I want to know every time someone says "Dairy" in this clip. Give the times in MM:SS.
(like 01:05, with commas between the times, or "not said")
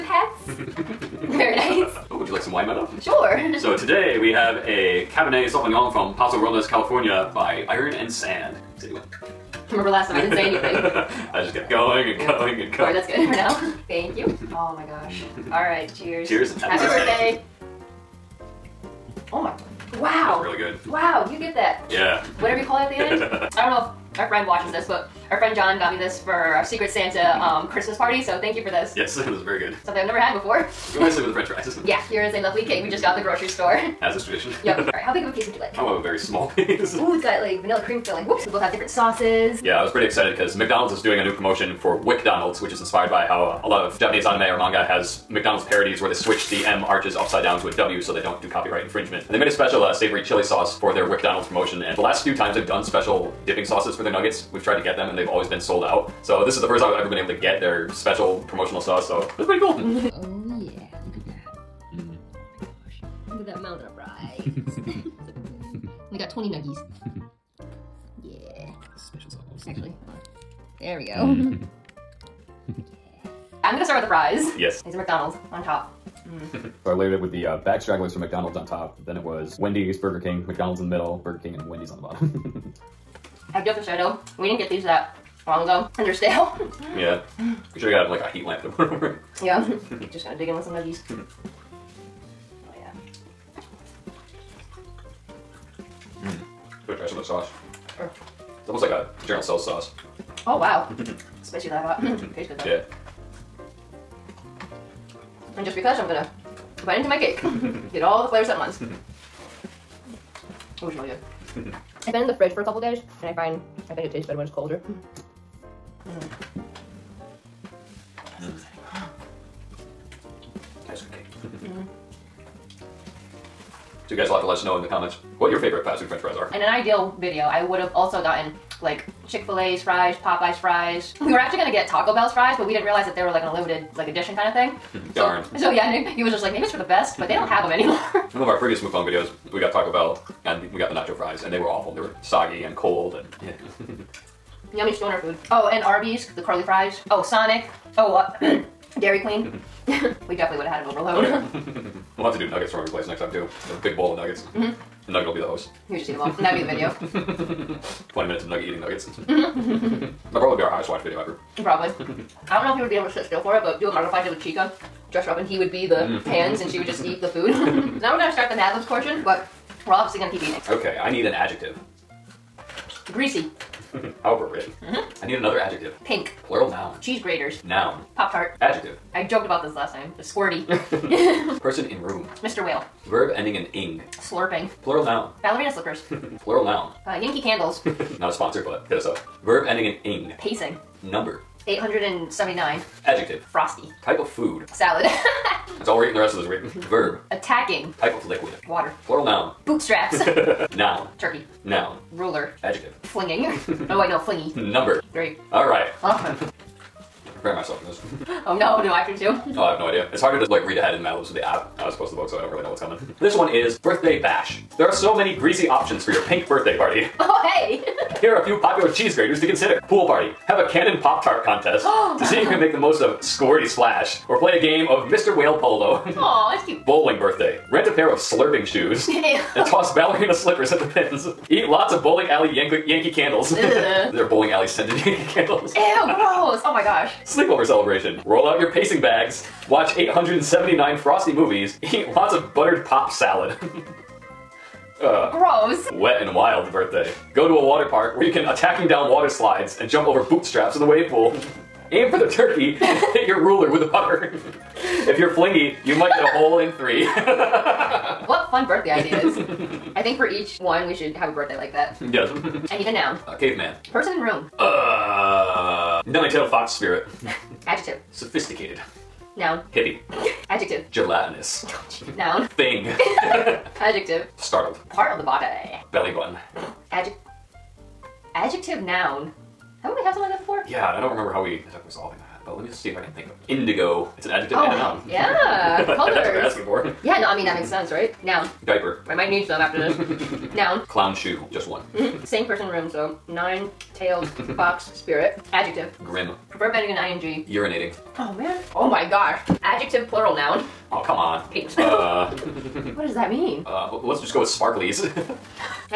02:28.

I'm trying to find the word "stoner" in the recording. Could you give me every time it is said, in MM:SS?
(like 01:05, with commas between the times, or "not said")
02:24.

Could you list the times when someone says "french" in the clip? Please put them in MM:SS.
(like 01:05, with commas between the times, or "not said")
00:31, 02:06.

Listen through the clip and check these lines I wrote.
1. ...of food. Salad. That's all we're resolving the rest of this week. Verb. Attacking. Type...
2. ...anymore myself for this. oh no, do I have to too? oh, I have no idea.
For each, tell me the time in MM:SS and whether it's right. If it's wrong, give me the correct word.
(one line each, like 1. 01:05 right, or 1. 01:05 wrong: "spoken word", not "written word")
1. 03:14 wrong: "eating", not "resolving"
2. 03:27 wrong: "prepare", not "anymore".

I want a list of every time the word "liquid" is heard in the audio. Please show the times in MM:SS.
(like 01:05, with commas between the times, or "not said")
03:18.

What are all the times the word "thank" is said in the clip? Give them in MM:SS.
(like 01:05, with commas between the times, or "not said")
00:13, 00:28.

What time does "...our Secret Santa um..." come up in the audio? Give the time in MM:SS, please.
00:26.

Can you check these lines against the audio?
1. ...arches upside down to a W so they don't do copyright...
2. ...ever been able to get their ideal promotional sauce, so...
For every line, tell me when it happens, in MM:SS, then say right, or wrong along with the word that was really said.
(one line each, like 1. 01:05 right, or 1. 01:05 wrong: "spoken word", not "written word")
1. 00:46 right
2. 00:56 wrong: "special", not "ideal".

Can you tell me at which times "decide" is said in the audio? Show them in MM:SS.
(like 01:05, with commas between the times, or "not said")
not said.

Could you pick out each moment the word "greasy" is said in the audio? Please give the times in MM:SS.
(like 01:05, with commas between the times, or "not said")
02:53, 03:35.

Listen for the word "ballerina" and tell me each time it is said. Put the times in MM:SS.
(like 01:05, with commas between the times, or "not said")
03:05, 03:49.